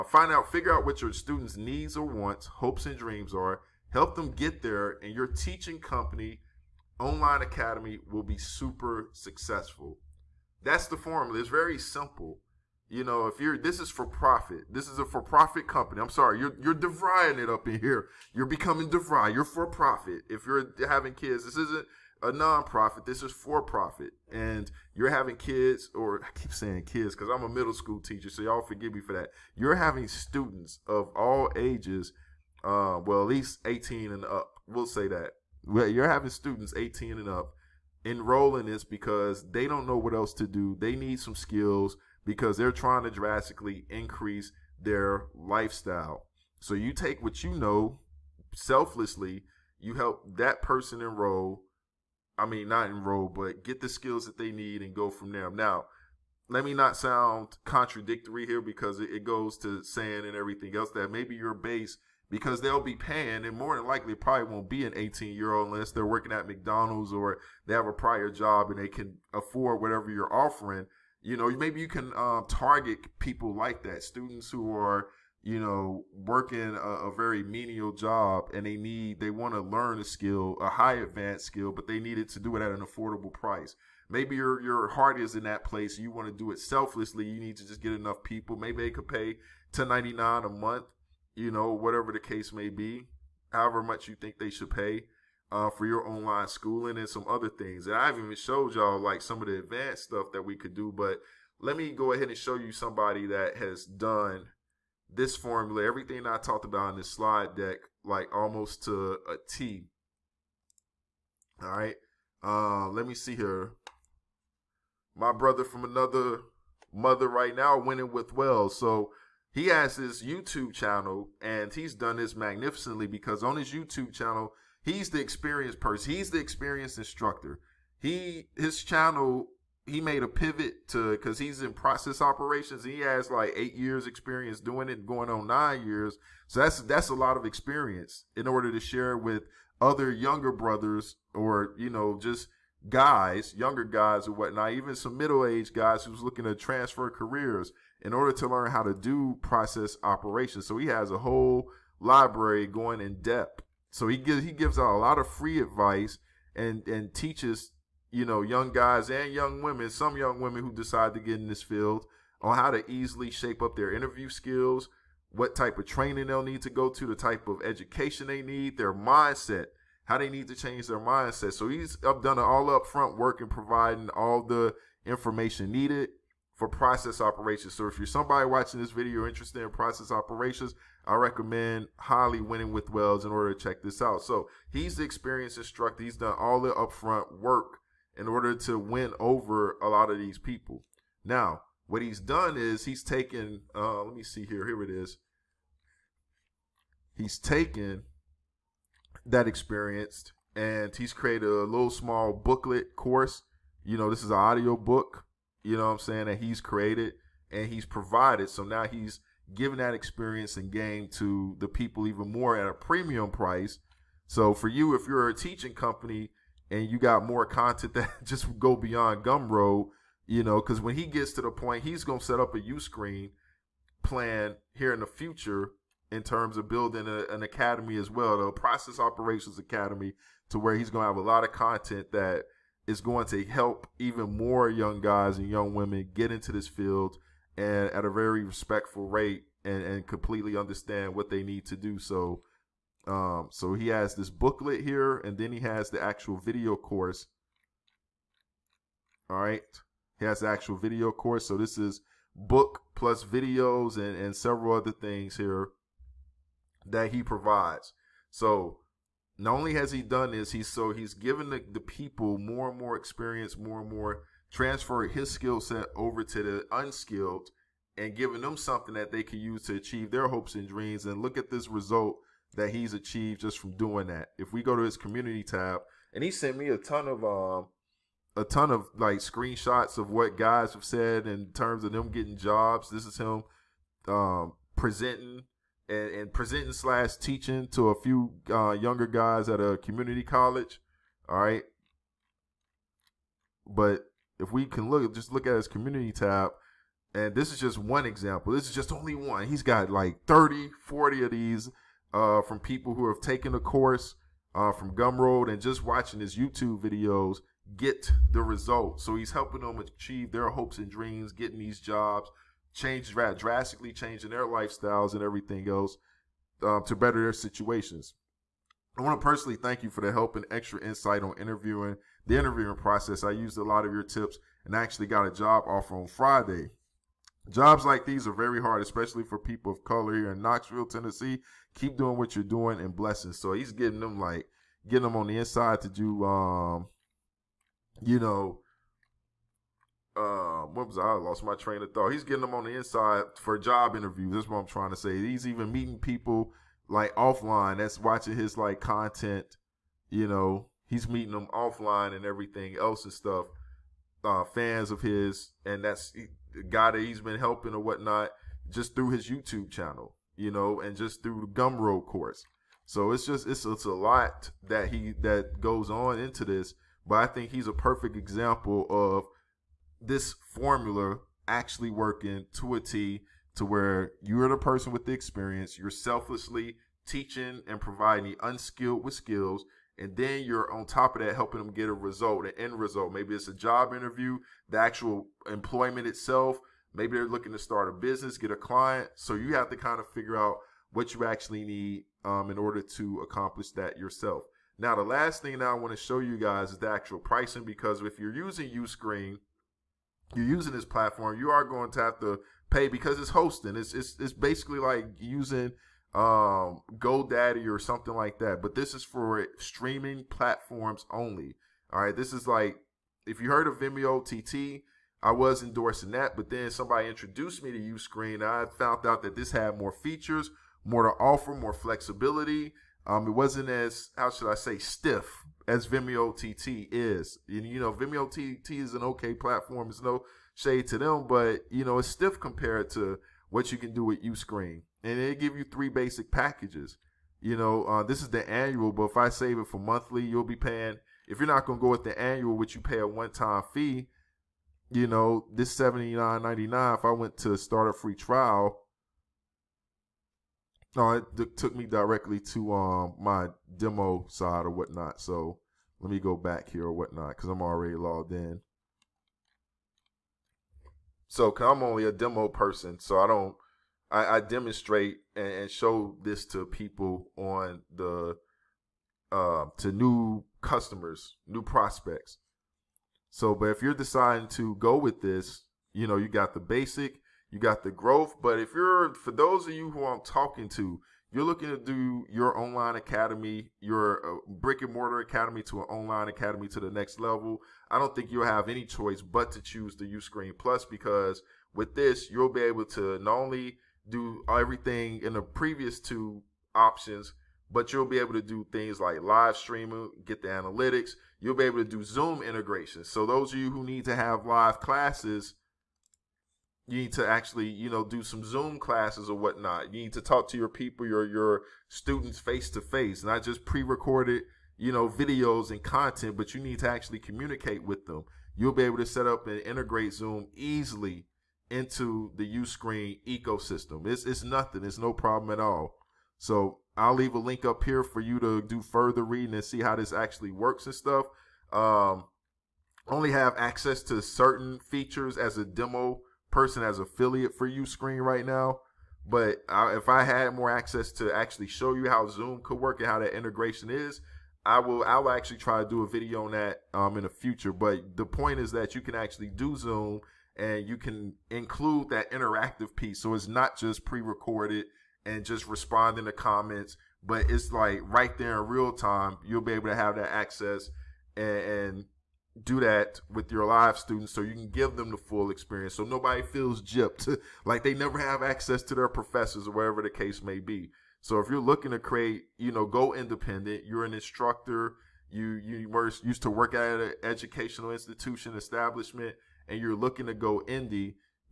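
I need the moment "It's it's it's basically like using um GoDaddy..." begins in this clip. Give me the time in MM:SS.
06:43.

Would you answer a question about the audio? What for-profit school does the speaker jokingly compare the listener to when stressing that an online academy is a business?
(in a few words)
DeVry.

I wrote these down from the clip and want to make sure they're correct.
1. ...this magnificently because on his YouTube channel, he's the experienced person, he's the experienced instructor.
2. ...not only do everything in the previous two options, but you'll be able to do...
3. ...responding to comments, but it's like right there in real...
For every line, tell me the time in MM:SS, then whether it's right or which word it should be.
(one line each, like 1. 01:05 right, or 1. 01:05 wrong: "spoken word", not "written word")
1. 02:02 right
2. 08:13 right
3. 09:15 right.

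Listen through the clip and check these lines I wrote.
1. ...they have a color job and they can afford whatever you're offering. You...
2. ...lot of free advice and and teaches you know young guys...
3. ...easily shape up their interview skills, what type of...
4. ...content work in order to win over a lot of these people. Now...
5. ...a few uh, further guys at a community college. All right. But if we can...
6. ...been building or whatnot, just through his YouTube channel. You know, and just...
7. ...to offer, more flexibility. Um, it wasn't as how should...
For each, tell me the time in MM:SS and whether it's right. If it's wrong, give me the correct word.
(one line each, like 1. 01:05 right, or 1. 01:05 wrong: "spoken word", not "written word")
1. 01:07 wrong: "prior", not "color"
2. 02:34 right
3. 02:42 right
4. 03:06 wrong: "upfront", not "content"
5. 04:47 wrong: "younger", not "further"
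6. 05:57 wrong: "helping", not "building"
7. 07:01 right.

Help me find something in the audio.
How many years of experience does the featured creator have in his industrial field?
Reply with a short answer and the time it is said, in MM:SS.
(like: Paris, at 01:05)
8, at 02:13.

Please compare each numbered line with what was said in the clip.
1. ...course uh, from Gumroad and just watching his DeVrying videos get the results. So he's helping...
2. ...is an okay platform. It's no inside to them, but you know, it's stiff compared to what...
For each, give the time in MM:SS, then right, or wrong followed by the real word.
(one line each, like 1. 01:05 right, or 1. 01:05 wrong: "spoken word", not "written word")
1. 05:03 wrong: "YouTube", not "DeVrying"
2. 07:08 wrong: "shade", not "inside".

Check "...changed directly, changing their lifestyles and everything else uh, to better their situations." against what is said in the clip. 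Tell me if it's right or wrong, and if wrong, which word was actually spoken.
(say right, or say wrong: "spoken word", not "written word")
wrong: "drastically", not "directly".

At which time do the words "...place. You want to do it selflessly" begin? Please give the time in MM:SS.
01:25.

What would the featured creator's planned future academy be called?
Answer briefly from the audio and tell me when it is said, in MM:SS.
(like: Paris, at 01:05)
Process Operations Academy, at 03:48.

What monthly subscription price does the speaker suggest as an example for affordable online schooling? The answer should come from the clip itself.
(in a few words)
10.99.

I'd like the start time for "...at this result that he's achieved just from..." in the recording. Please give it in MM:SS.
04:31.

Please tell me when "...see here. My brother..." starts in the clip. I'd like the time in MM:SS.
01:53.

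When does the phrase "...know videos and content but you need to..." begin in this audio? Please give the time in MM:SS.
08:34.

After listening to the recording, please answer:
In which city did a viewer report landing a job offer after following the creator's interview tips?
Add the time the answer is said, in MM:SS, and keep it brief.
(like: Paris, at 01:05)
Knoxville, at 05:30.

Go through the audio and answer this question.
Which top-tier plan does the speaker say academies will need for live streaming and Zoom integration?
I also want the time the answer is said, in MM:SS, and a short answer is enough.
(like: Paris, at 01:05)
Uscreen Plus, at 08:10.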